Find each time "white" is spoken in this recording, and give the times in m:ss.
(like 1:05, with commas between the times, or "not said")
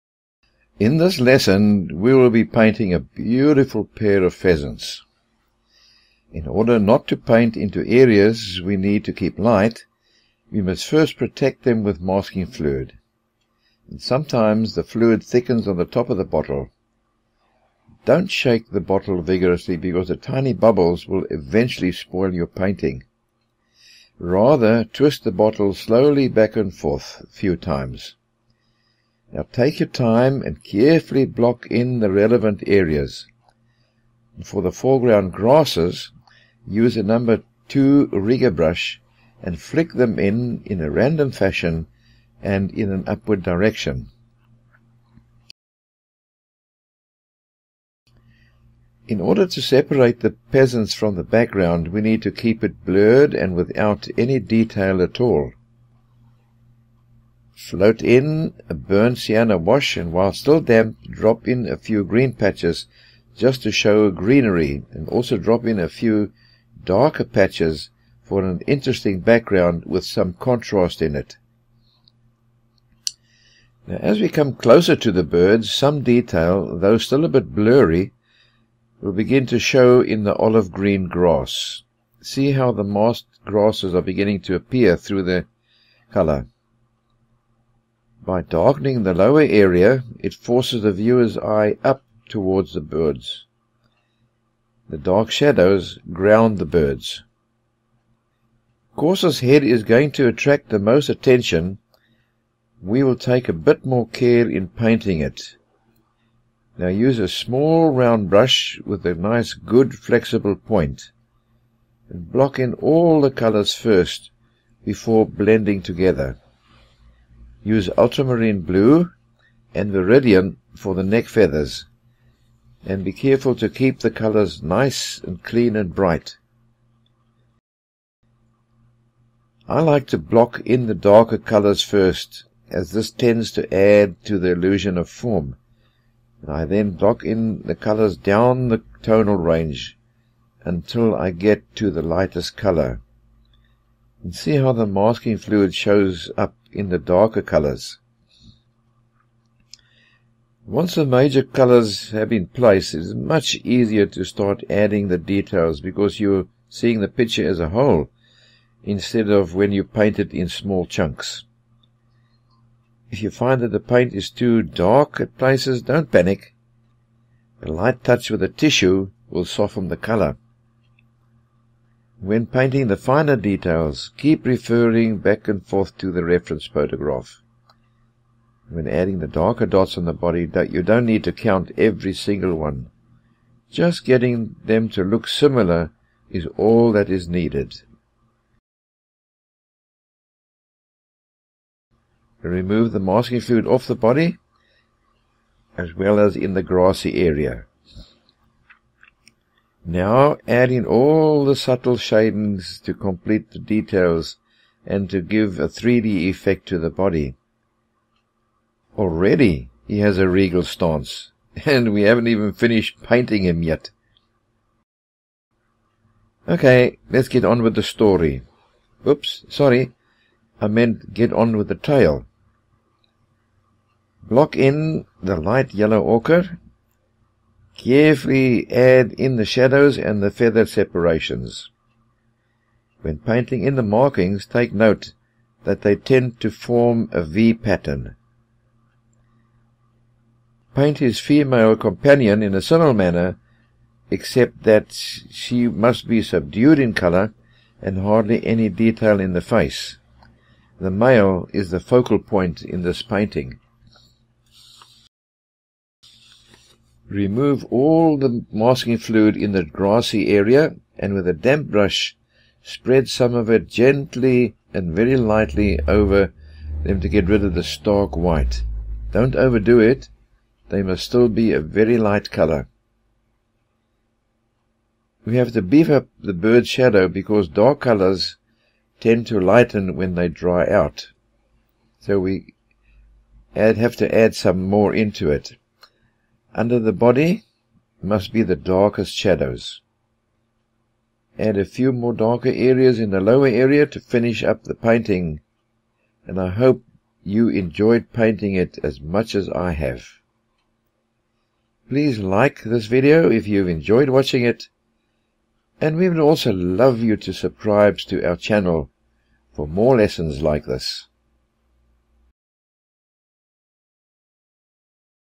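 4:28.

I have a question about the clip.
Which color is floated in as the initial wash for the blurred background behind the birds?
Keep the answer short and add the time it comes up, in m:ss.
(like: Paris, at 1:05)
Burnt sienna, at 0:58.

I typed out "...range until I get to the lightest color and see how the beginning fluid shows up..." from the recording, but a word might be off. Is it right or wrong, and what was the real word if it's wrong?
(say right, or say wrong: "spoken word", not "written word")
wrong: "masking", not "beginning".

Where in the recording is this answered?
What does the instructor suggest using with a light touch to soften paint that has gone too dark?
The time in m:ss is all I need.
2:48.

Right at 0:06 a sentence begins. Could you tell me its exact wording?
In order not to paint into areas we need to keep light, we must first protect them with masking fluid.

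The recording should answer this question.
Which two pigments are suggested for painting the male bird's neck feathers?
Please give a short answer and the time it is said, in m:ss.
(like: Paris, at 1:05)
Ultramarine blue and viridian, at 1:57.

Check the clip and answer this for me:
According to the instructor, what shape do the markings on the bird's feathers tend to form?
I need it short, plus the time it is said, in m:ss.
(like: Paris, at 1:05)
V pattern, at 3:57.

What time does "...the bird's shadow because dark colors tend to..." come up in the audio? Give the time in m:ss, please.
4:36.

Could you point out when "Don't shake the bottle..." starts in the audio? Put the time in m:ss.
0:18.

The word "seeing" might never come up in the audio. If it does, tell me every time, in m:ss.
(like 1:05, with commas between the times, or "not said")
2:36.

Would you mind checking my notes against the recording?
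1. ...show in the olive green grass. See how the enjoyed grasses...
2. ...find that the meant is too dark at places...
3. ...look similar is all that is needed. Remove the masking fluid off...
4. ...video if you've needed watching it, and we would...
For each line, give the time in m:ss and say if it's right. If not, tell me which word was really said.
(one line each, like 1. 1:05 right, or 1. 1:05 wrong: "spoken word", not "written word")
1. 1:19 wrong: "mossed", not "enjoyed"
2. 2:43 wrong: "paint", not "meant"
3. 3:05 right
4. 5:02 wrong: "enjoyed", not "needed".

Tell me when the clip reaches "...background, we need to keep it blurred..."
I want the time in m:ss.
0:51.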